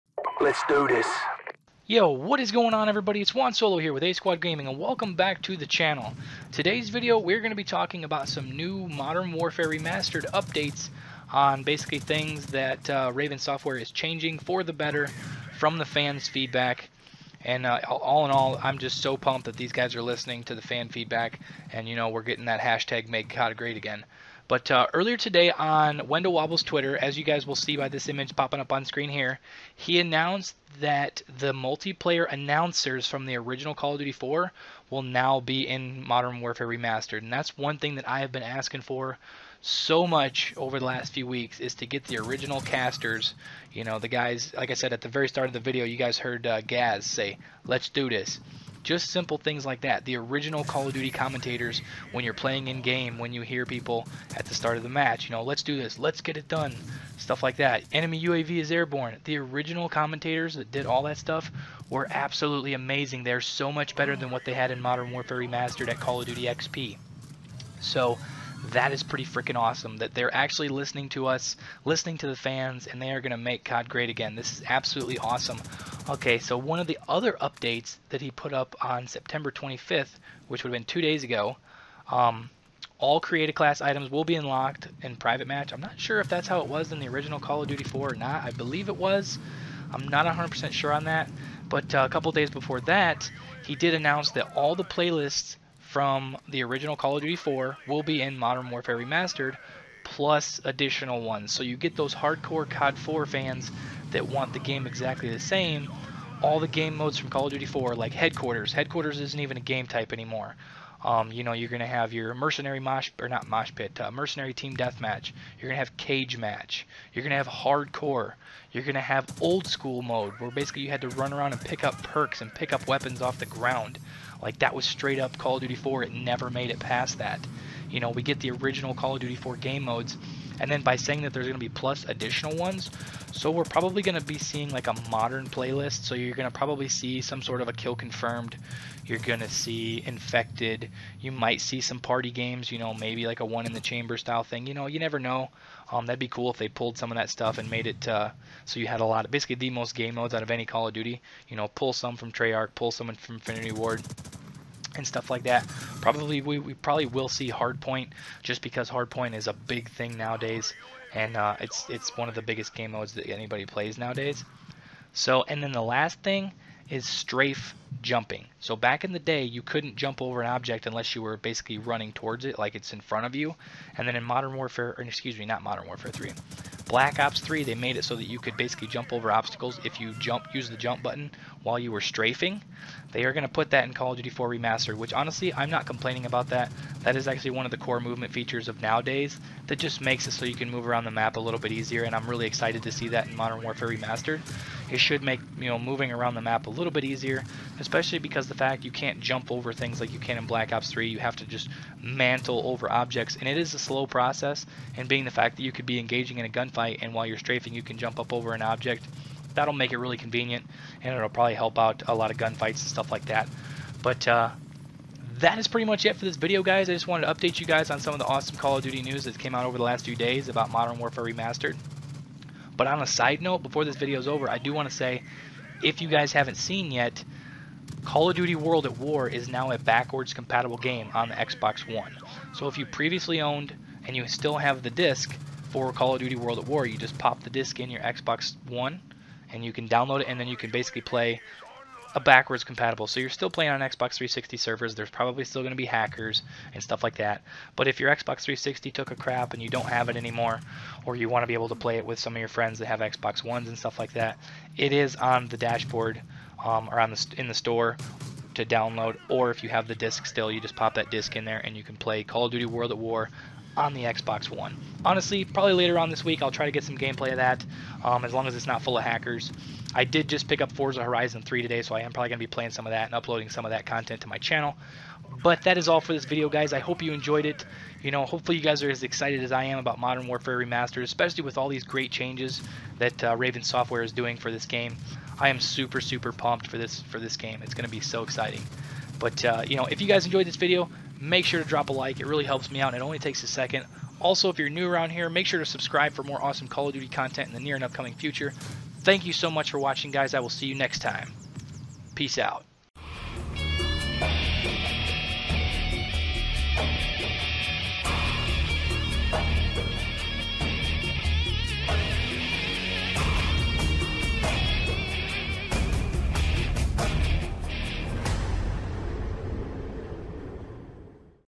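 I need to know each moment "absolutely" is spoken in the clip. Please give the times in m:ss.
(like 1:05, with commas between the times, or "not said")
1:02, 1:14.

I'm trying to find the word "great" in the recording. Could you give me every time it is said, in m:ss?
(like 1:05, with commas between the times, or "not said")
0:23, 1:13, 4:41.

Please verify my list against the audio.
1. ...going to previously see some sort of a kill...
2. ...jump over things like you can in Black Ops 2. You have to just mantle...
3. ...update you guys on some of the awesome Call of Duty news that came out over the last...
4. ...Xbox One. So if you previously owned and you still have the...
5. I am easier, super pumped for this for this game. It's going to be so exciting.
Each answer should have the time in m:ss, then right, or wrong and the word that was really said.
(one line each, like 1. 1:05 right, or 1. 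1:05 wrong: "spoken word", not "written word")
1. 2:16 wrong: "probably", not "previously"
2. 3:19 wrong: "3", not "2"
3. 3:37 right
4. 3:51 right
5. 4:45 wrong: "super", not "easier".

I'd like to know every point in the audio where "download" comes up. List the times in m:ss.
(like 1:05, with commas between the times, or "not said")
3:59, 4:18.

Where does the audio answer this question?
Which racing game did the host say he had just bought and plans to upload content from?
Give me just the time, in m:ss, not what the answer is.
4:30.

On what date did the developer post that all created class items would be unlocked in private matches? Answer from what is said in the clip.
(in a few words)
September 25th.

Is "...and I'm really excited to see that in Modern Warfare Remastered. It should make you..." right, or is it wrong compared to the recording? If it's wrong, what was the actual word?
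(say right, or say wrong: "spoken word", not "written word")
right.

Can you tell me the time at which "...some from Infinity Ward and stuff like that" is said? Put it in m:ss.
2:32.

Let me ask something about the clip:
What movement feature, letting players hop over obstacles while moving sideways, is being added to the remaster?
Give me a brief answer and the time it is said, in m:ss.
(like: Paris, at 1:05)
Strafe jumping, at 2:47.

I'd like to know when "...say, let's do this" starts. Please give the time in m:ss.
0:47.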